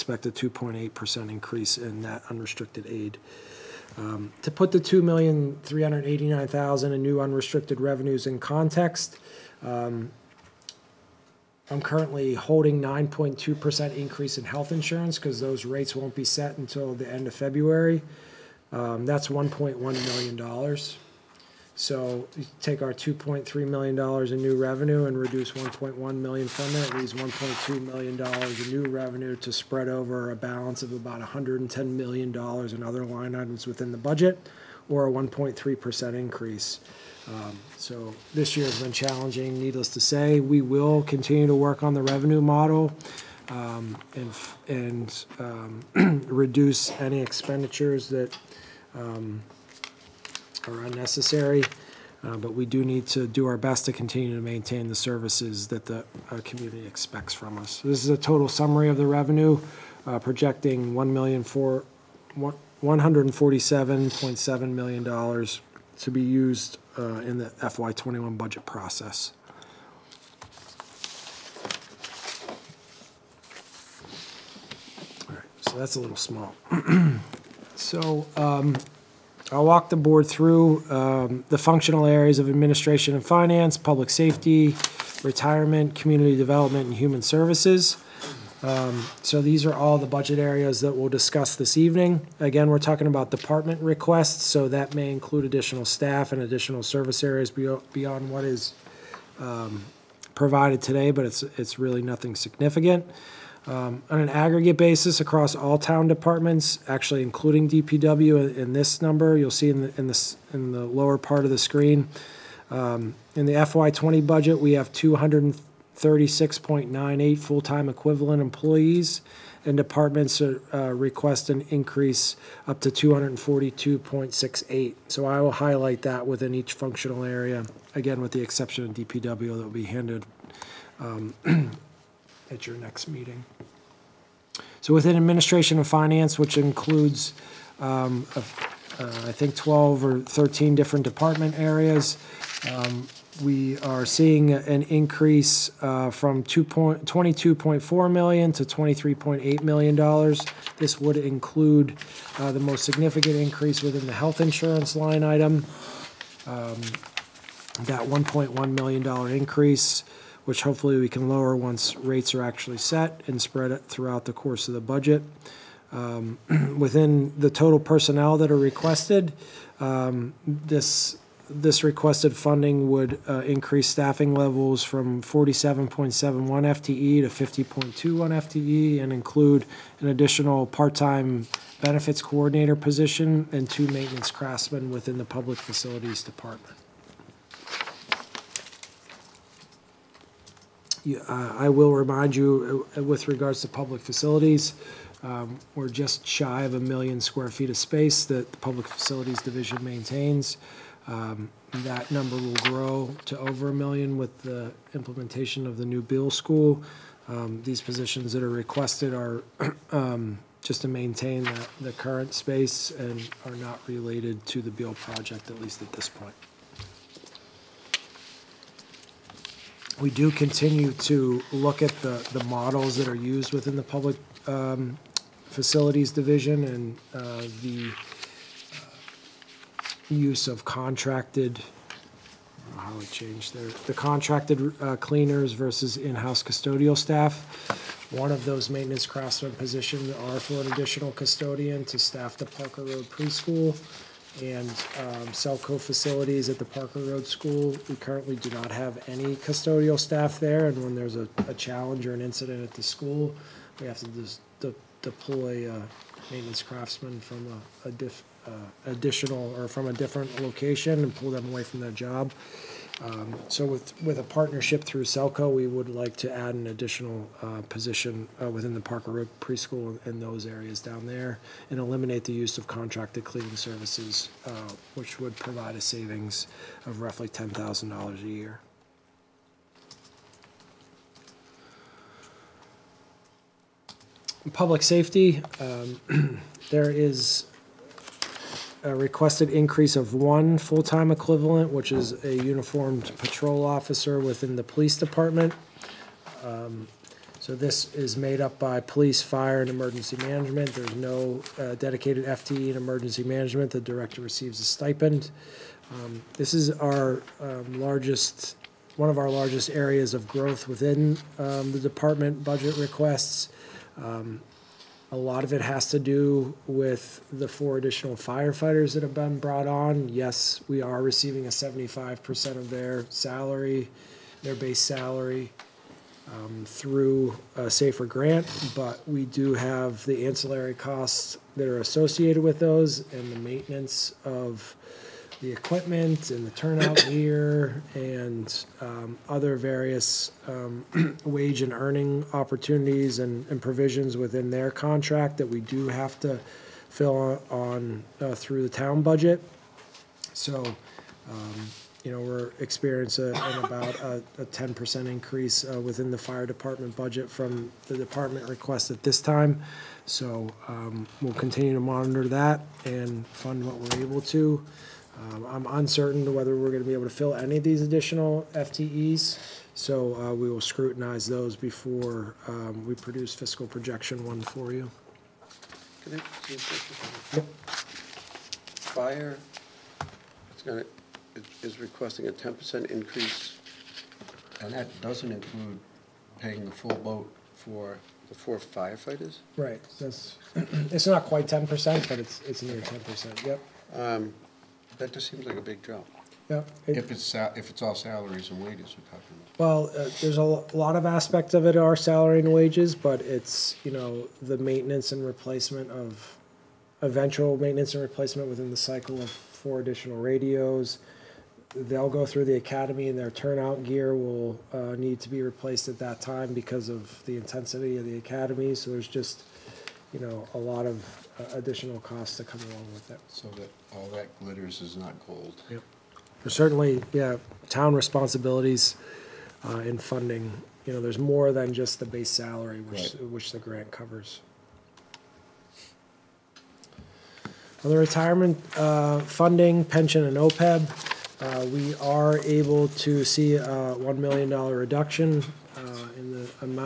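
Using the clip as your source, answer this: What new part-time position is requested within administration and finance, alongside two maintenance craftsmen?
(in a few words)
benefits coordinator.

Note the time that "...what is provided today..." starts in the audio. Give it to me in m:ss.
1:38.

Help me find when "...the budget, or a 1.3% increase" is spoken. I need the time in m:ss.
0:33.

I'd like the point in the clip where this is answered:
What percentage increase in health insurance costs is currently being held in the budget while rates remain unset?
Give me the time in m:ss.
0:12.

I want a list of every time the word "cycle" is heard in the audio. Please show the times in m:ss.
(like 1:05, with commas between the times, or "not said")
6:48.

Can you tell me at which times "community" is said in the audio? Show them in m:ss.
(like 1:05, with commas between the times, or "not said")
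0:56, 1:25.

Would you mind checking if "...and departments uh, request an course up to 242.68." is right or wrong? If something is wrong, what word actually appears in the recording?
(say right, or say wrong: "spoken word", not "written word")
wrong: "increase", not "course".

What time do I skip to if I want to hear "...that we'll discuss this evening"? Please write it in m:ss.
1:30.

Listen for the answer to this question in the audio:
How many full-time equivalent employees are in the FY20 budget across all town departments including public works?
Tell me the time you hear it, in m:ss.
1:54.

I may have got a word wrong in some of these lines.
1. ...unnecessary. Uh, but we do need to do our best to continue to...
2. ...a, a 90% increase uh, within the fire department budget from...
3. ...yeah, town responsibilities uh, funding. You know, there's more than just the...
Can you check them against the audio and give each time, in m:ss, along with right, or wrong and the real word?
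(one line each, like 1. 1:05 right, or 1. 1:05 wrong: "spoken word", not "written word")
1. 0:50 right
2. 5:54 wrong: "10", not "90"
3. 7:07 right.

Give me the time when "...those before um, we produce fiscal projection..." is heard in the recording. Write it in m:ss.
6:11.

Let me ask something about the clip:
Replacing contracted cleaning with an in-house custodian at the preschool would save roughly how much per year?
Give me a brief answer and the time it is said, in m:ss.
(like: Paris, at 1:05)
$10,000, at 4:37.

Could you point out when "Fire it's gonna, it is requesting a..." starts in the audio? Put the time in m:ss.
6:18.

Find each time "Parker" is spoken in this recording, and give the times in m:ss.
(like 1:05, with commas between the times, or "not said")
4:02, 4:06, 4:28.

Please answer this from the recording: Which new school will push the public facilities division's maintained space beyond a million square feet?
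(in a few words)
Beal School.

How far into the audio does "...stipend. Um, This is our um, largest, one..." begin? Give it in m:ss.
5:04.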